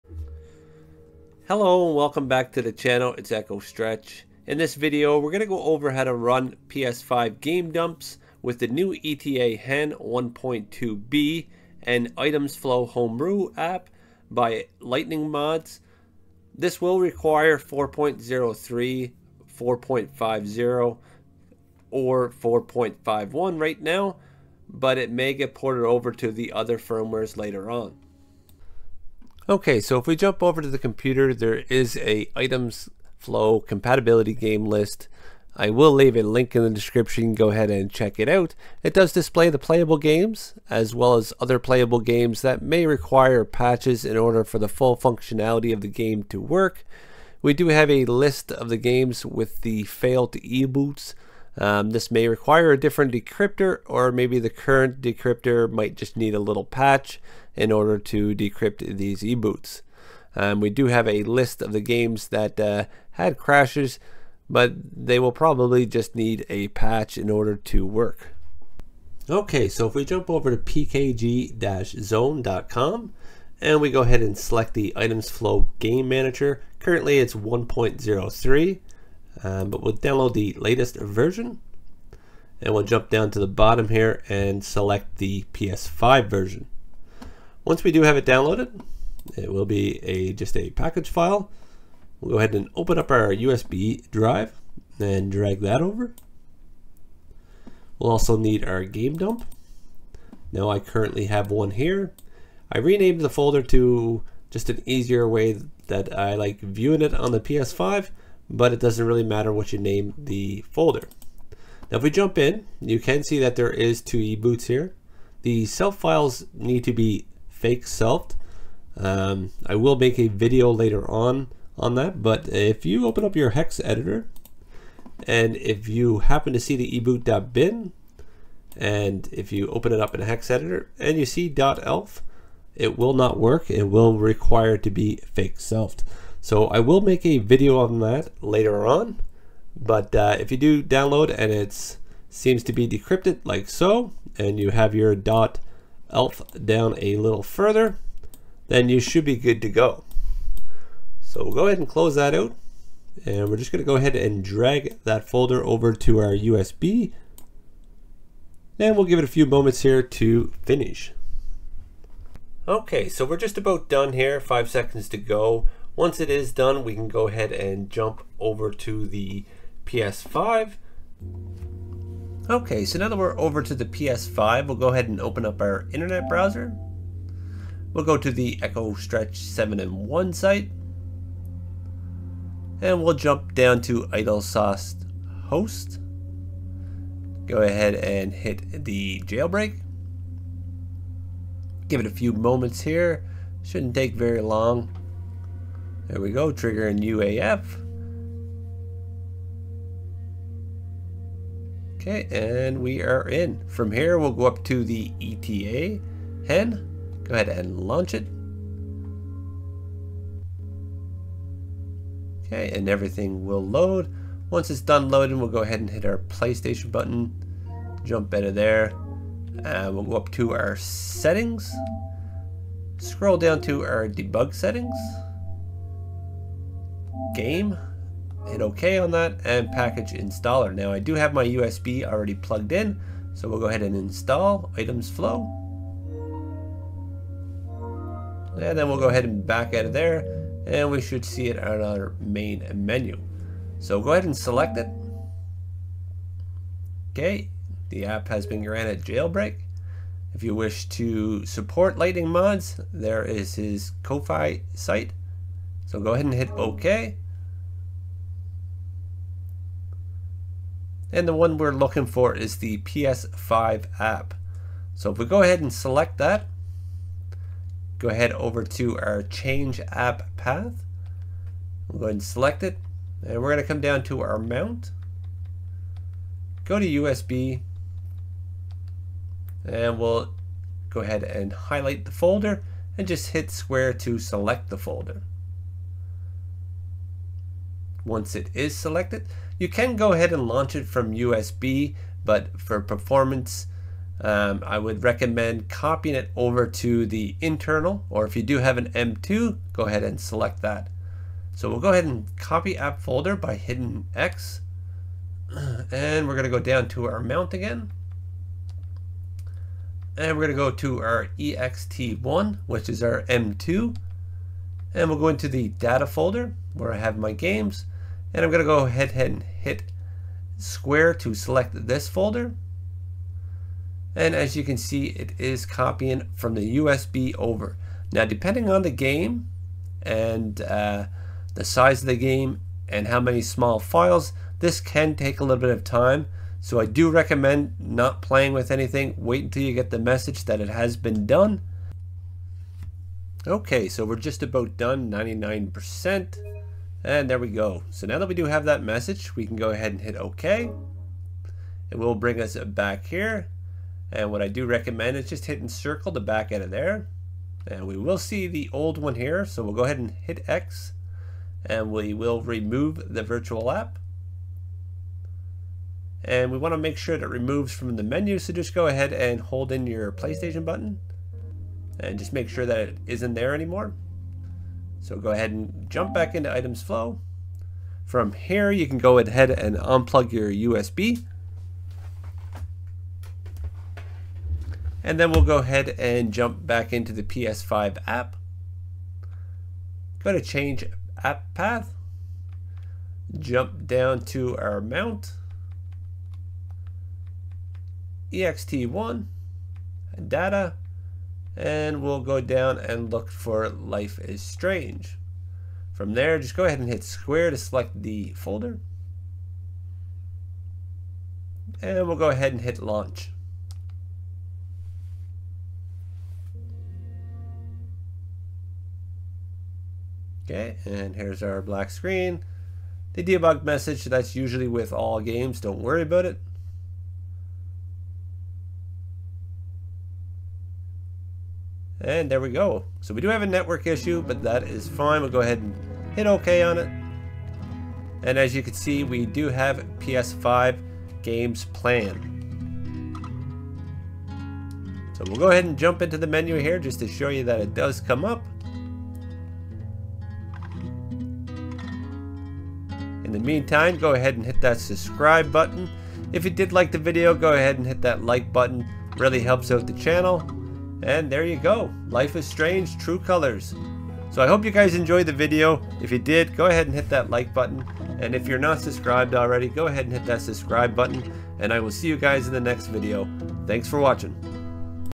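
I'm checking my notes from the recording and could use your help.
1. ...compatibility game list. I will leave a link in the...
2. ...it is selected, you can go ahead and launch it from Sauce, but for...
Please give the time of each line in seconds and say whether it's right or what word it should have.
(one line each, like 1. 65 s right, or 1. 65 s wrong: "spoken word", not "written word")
1. 33 s right
2. 288 s wrong: "USB", not "Sauce".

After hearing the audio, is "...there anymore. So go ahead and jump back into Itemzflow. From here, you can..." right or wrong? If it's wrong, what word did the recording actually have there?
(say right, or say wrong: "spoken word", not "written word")
right.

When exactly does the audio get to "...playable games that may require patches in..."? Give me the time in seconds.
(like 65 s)
41 s.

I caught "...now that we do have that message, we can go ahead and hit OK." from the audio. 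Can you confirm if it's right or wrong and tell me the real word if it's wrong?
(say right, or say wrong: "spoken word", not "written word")
right.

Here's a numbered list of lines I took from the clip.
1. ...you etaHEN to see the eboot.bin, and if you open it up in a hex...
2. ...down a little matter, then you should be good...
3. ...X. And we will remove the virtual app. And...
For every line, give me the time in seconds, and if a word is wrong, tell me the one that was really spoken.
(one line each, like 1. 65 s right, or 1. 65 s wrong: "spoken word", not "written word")
1. 125 s wrong: "happen", not "etaHEN"
2. 146 s wrong: "further", not "matter"
3. 360 s right.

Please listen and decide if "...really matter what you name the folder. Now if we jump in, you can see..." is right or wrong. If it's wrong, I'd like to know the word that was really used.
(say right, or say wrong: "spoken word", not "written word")
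right.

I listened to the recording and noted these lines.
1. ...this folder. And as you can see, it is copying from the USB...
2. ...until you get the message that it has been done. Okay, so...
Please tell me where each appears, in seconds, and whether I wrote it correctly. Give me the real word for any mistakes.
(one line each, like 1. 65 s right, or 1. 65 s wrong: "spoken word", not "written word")
1. 321 s right
2. 339 s right.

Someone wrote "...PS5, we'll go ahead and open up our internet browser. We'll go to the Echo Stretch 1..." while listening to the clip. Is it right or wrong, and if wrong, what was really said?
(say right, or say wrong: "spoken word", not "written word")
wrong: "7", not "1".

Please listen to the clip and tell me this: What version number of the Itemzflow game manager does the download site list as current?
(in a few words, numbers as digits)
1.03.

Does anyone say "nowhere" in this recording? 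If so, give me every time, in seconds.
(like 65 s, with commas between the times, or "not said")
not said.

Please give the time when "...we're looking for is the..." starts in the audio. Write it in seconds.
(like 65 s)
261 s.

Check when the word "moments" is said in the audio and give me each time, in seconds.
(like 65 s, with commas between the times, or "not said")
159 s, 192 s.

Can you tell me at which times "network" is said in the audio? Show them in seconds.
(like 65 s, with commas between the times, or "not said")
433 s.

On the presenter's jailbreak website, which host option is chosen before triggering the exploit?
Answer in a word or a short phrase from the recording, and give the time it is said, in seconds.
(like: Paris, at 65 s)
Idle Sauce Host, at 184 s.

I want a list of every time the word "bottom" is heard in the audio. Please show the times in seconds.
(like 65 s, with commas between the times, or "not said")
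83 s.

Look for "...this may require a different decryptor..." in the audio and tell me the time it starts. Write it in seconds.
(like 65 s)
51 s.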